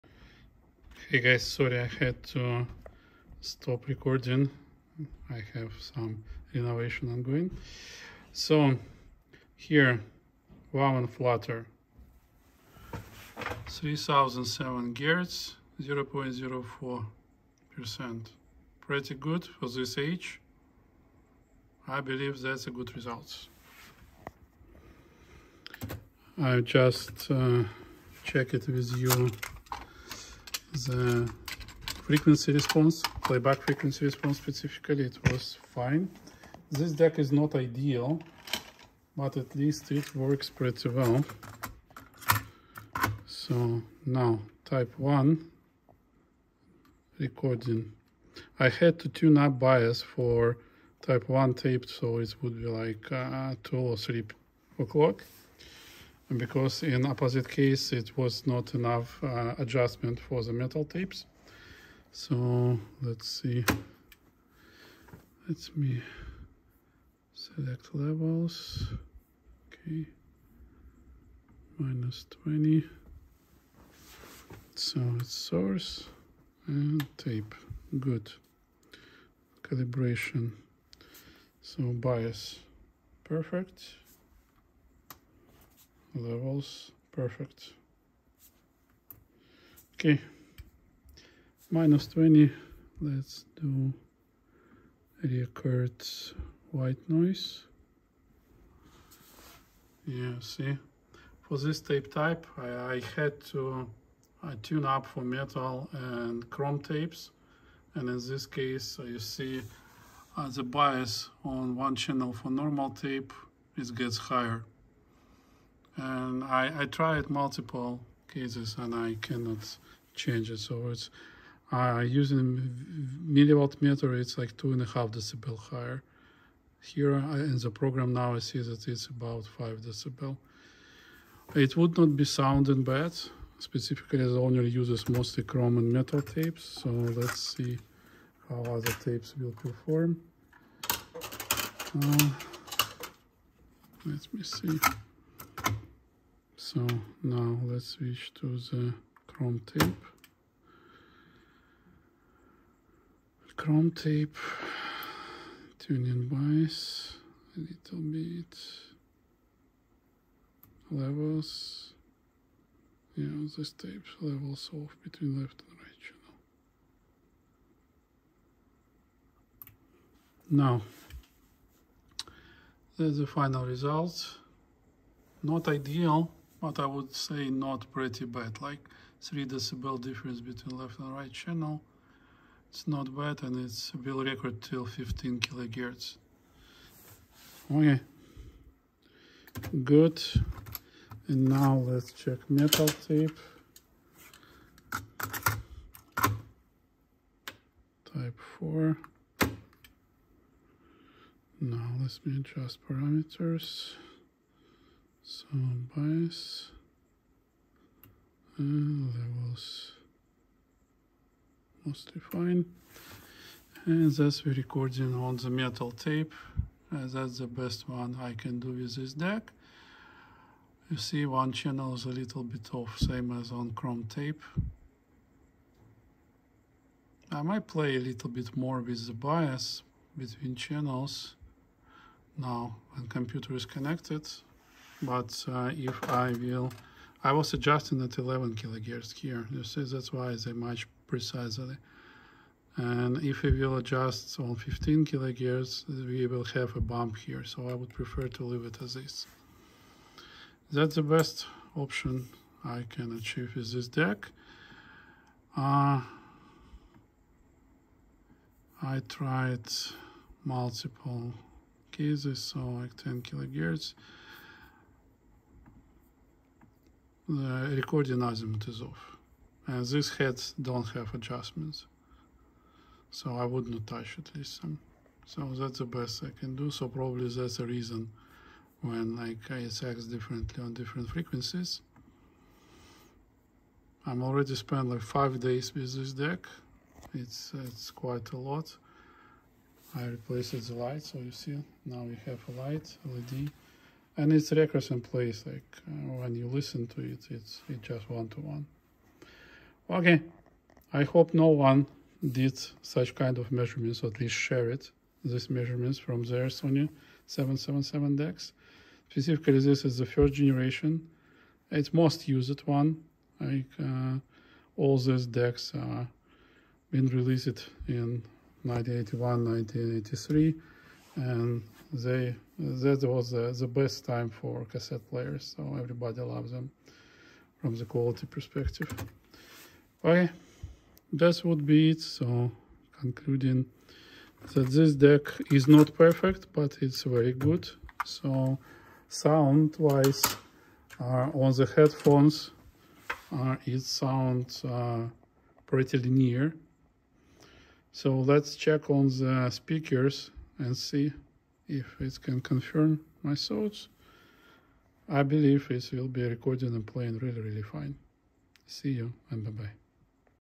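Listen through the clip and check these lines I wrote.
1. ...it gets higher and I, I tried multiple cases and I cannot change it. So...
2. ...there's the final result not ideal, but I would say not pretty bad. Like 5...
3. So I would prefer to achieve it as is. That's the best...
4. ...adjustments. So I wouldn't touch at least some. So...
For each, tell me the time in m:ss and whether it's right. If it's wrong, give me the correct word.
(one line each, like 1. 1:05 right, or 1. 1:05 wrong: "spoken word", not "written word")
1. 1:53 right
2. 2:52 wrong: "3", not "5"
3. 4:07 wrong: "leave", not "achieve"
4. 4:31 right.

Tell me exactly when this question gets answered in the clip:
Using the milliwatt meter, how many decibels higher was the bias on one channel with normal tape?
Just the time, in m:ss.
2:04.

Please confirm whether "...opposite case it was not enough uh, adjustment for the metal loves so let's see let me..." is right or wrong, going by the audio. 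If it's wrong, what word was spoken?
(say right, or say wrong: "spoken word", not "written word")
wrong: "tapes", not "loves".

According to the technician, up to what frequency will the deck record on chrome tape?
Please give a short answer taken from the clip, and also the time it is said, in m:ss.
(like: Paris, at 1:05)
15 kilohertz, at 3:04.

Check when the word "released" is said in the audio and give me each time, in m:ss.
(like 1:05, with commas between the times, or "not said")
5:17.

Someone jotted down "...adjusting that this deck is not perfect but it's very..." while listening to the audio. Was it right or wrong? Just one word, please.
wrong.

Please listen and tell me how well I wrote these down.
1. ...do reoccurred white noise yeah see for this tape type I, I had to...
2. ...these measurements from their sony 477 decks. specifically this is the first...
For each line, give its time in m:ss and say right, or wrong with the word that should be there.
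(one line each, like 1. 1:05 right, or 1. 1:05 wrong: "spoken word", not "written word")
1. 1:33 right
2. 5:05 wrong: "777", not "477".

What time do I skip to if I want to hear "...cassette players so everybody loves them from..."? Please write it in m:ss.
5:24.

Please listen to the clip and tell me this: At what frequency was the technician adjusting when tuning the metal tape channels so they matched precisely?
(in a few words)
11 kilohertz.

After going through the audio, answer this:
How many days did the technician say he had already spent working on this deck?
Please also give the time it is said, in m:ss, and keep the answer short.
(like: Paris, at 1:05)
5 days, at 4:45.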